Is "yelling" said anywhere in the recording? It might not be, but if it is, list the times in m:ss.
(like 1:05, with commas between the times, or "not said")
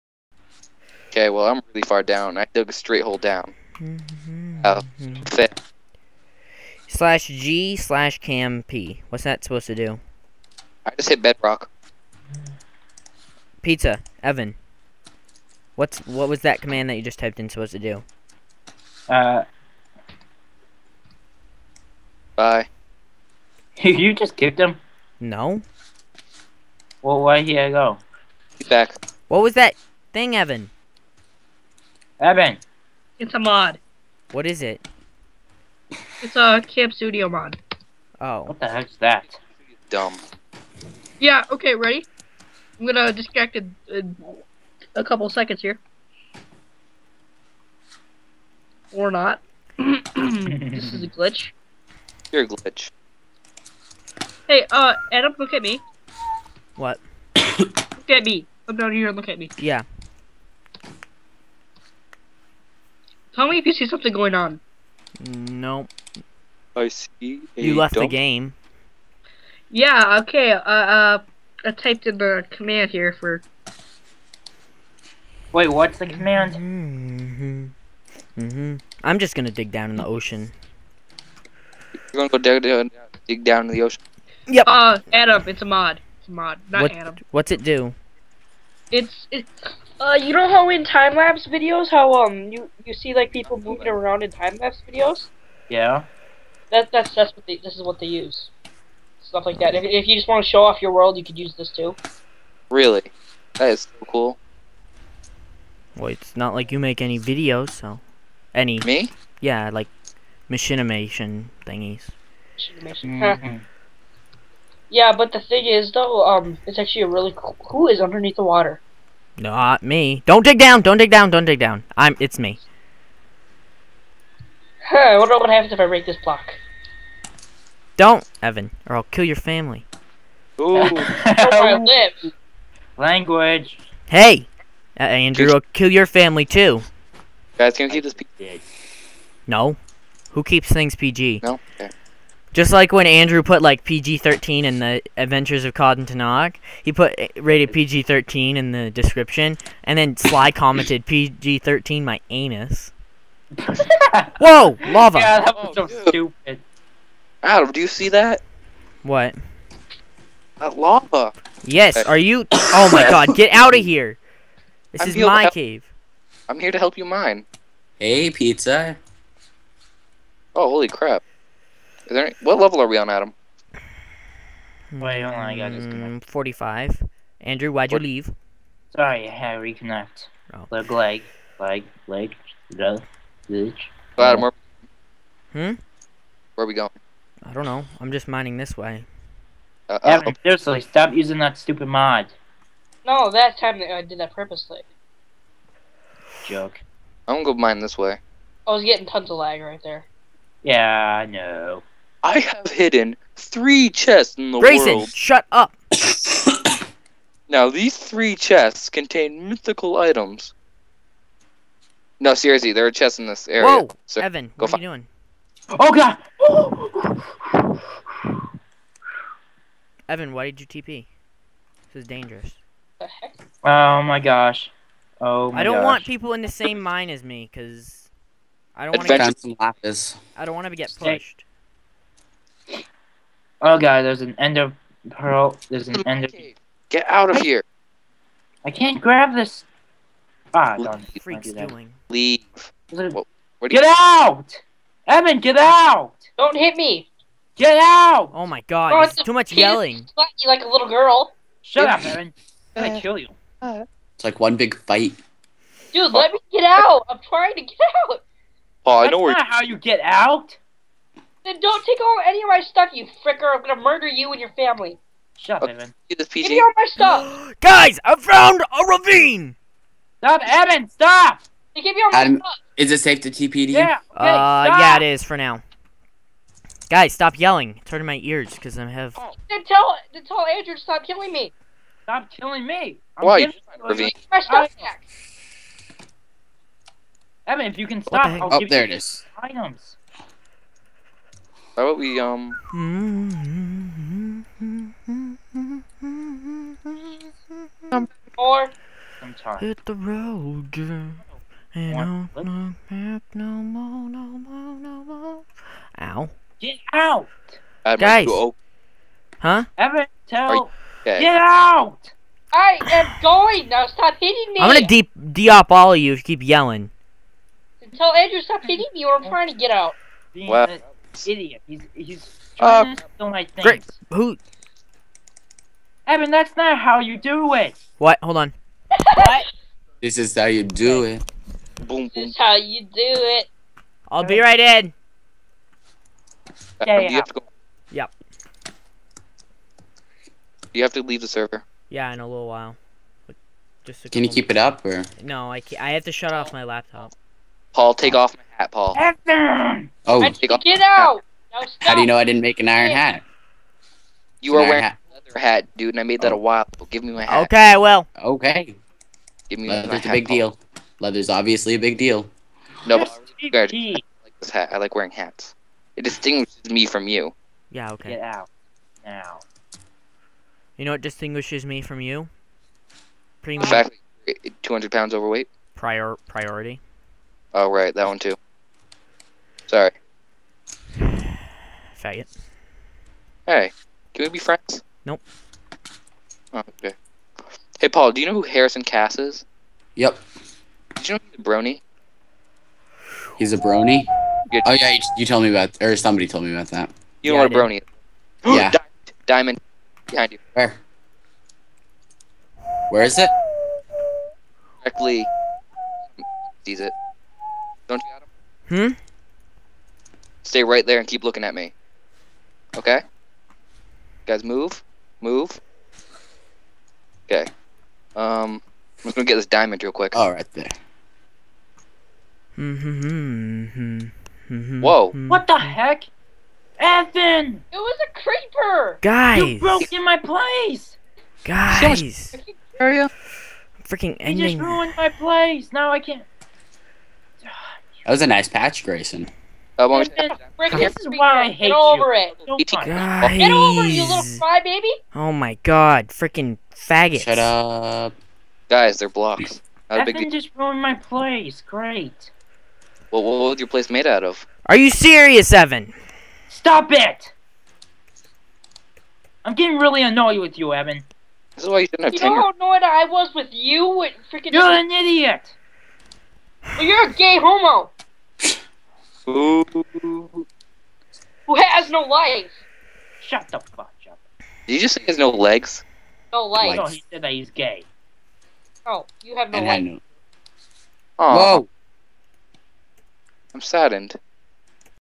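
4:09, 4:37, 5:16.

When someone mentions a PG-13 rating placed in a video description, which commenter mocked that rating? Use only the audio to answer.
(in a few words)
Sly.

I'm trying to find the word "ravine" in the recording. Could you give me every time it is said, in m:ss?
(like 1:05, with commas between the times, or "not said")
4:28, 4:43.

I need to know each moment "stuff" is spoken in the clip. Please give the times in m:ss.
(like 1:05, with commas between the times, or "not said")
1:39, 4:22, 4:26, 4:32, 4:44.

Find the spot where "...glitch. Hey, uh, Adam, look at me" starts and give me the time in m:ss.
0:52.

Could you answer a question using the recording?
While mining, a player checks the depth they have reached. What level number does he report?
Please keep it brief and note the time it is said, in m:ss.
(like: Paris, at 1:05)
45, at 2:56.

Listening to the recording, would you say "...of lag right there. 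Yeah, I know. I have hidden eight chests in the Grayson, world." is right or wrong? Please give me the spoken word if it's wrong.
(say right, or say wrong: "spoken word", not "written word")
wrong: "three", not "eight".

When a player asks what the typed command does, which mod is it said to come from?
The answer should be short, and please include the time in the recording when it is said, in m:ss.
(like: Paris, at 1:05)
Camp Studio mod, at 0:36.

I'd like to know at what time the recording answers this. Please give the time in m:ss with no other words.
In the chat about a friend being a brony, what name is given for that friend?
6:28.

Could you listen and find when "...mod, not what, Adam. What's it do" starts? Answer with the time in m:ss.
1:26.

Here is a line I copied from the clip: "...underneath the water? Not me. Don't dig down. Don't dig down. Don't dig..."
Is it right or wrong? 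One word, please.
right.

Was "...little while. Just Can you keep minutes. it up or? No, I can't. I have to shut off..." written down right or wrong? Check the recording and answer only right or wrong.
right.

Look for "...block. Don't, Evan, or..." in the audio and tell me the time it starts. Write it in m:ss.
2:06.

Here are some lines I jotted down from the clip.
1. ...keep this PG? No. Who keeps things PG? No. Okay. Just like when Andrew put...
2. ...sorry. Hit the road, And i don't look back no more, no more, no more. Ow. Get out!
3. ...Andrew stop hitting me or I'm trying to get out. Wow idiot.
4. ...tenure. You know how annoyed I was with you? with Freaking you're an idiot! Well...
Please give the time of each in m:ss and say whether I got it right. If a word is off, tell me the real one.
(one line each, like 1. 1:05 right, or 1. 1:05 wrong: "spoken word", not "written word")
1. 2:17 right
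2. 4:59 right
3. 5:18 right
4. 7:42 right.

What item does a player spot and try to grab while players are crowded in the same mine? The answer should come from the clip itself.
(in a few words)
Ender pearl.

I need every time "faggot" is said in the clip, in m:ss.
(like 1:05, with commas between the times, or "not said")
6:22, 7:26.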